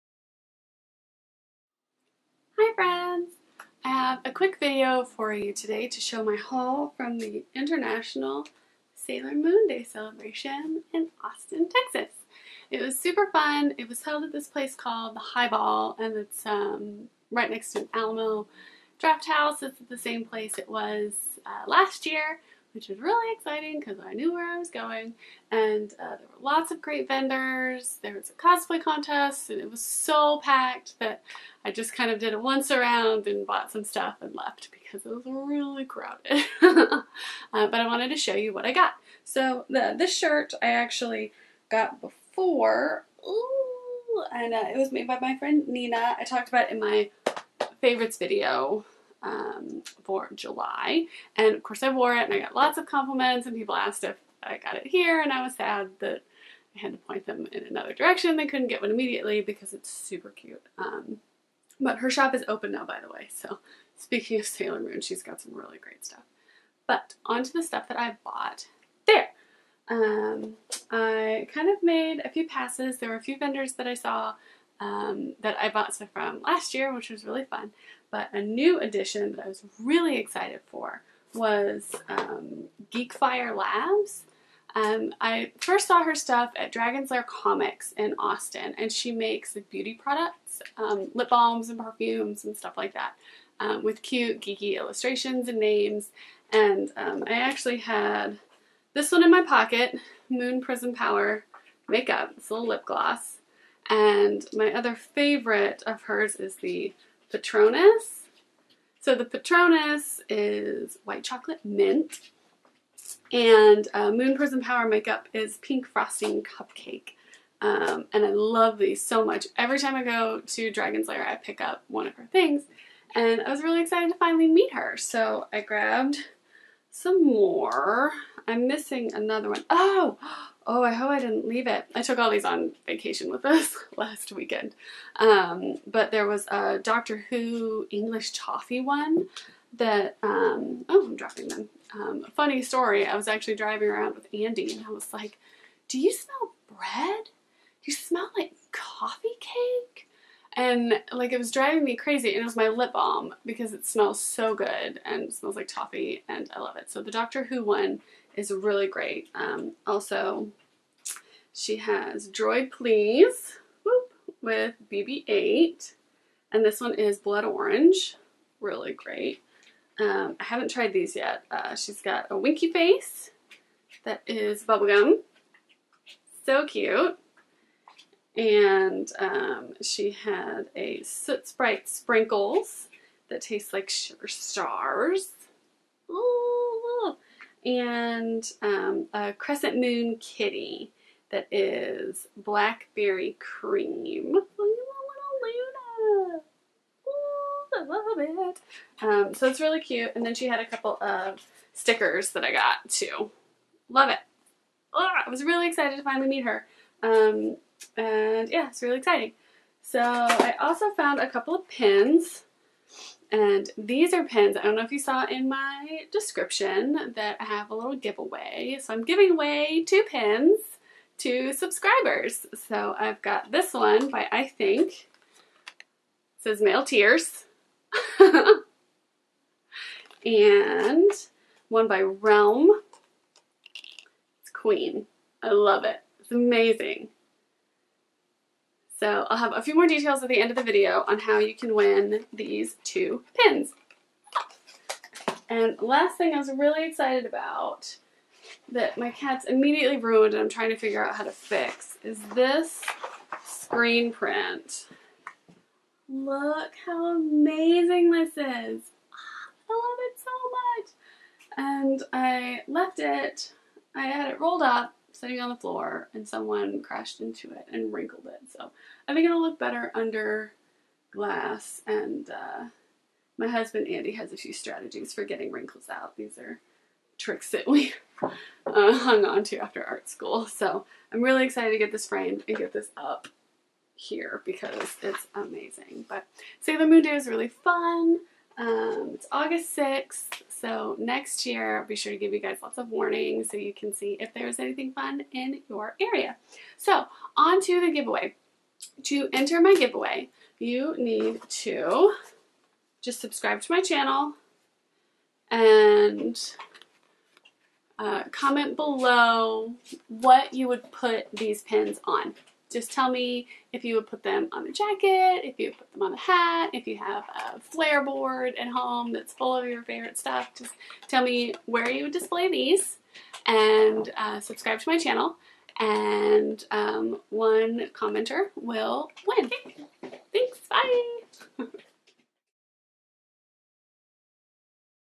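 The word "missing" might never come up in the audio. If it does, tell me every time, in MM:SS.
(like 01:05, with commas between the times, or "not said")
02:08.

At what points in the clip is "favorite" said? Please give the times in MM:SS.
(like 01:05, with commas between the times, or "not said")
00:47, 01:44, 05:19.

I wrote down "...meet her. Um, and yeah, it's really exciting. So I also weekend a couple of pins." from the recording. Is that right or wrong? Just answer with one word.
wrong.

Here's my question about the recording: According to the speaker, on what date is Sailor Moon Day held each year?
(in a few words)
August 6th.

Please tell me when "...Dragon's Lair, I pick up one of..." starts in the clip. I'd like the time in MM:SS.
02:00.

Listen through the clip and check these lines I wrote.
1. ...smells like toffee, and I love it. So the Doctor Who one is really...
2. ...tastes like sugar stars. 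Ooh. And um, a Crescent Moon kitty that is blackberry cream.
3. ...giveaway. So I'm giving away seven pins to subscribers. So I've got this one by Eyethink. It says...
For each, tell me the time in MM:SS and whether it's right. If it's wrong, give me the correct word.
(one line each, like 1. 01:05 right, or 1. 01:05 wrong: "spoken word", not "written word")
1. 02:35 right
2. 03:03 right
3. 03:37 wrong: "two", not "seven".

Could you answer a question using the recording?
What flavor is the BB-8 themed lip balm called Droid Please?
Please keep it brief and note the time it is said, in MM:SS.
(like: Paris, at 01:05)
Blood Orange, at 02:47.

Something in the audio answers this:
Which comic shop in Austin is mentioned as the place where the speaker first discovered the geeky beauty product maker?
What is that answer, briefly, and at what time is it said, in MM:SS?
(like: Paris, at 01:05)
Dragon's Lair Comics, at 01:26.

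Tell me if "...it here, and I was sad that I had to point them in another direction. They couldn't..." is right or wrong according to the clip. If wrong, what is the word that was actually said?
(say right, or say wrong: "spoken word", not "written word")
right.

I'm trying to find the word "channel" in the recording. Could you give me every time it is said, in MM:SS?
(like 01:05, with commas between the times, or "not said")
05:03, 05:24.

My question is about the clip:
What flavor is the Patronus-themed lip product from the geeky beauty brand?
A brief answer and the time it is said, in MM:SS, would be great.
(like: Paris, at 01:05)
white chocolate mint, at 01:51.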